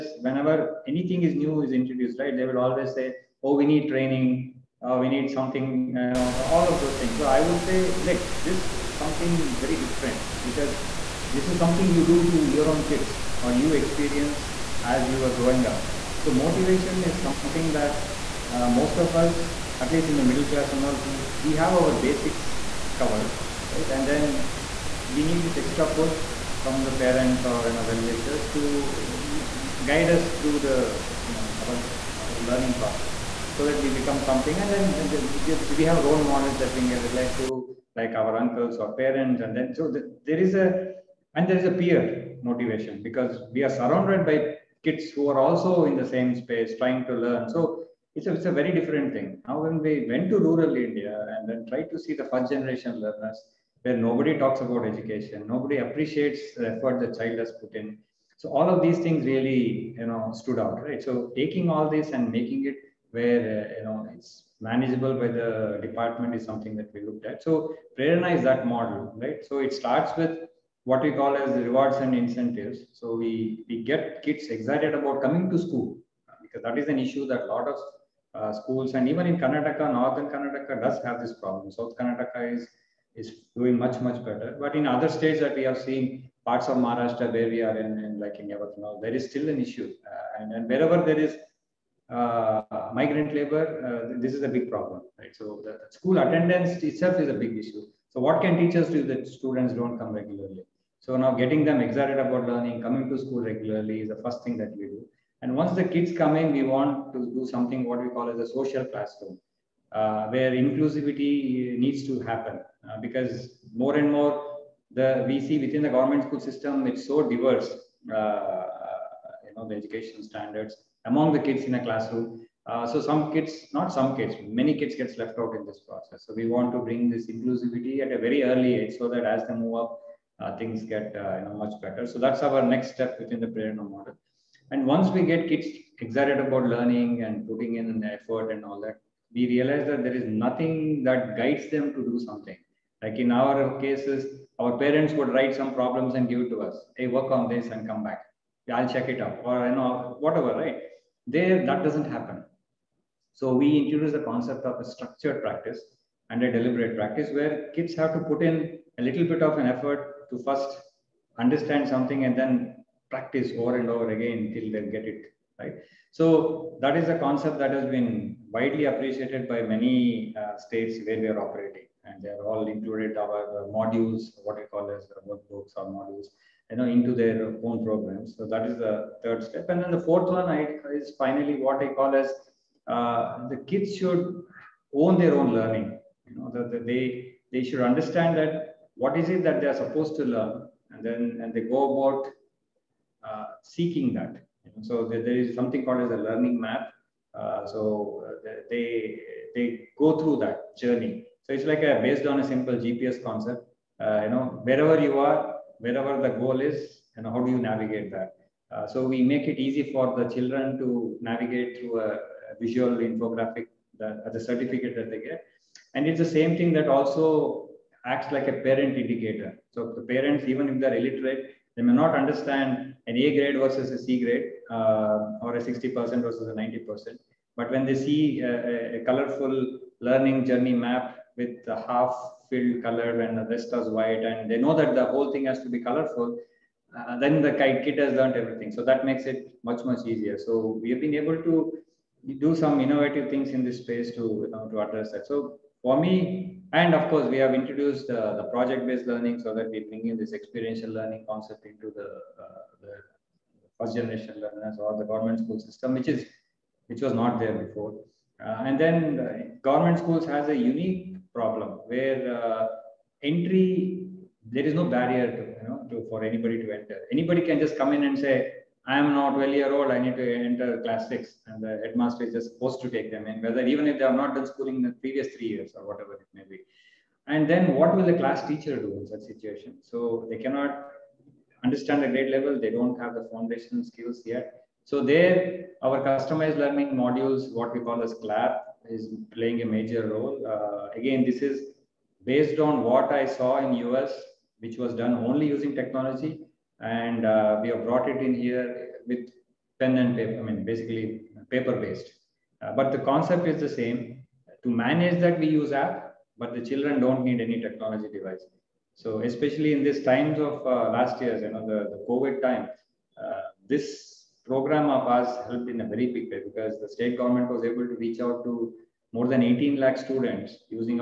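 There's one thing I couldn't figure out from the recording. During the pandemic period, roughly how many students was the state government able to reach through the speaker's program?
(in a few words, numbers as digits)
18 lakh.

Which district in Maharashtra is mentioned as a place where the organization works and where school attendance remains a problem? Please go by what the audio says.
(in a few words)
Yavatmal.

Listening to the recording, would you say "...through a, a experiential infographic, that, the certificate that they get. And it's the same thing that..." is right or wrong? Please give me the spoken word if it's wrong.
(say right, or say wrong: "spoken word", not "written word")
wrong: "visual", not "experiential".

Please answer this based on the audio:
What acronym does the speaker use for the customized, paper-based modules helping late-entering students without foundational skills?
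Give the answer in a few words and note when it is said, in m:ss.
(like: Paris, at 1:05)
CLAP, at 4:48.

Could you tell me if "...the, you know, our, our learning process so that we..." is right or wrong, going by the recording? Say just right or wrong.
right.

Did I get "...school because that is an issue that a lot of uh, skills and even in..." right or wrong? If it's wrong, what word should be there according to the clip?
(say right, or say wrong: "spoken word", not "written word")
wrong: "schools", not "skills".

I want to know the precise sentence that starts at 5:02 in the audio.
Uh, but the concept is the same.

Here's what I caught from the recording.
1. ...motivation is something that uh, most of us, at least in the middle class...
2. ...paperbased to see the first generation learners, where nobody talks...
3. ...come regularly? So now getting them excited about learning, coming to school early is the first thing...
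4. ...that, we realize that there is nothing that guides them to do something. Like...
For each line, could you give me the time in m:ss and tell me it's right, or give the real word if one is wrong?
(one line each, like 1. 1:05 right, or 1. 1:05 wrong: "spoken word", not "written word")
1. 0:16 right
2. 0:51 wrong: "tried", not "paperbased"
3. 1:39 wrong: "regularly", not "early"
4. 2:18 right.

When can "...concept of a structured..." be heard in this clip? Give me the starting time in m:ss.
2:34.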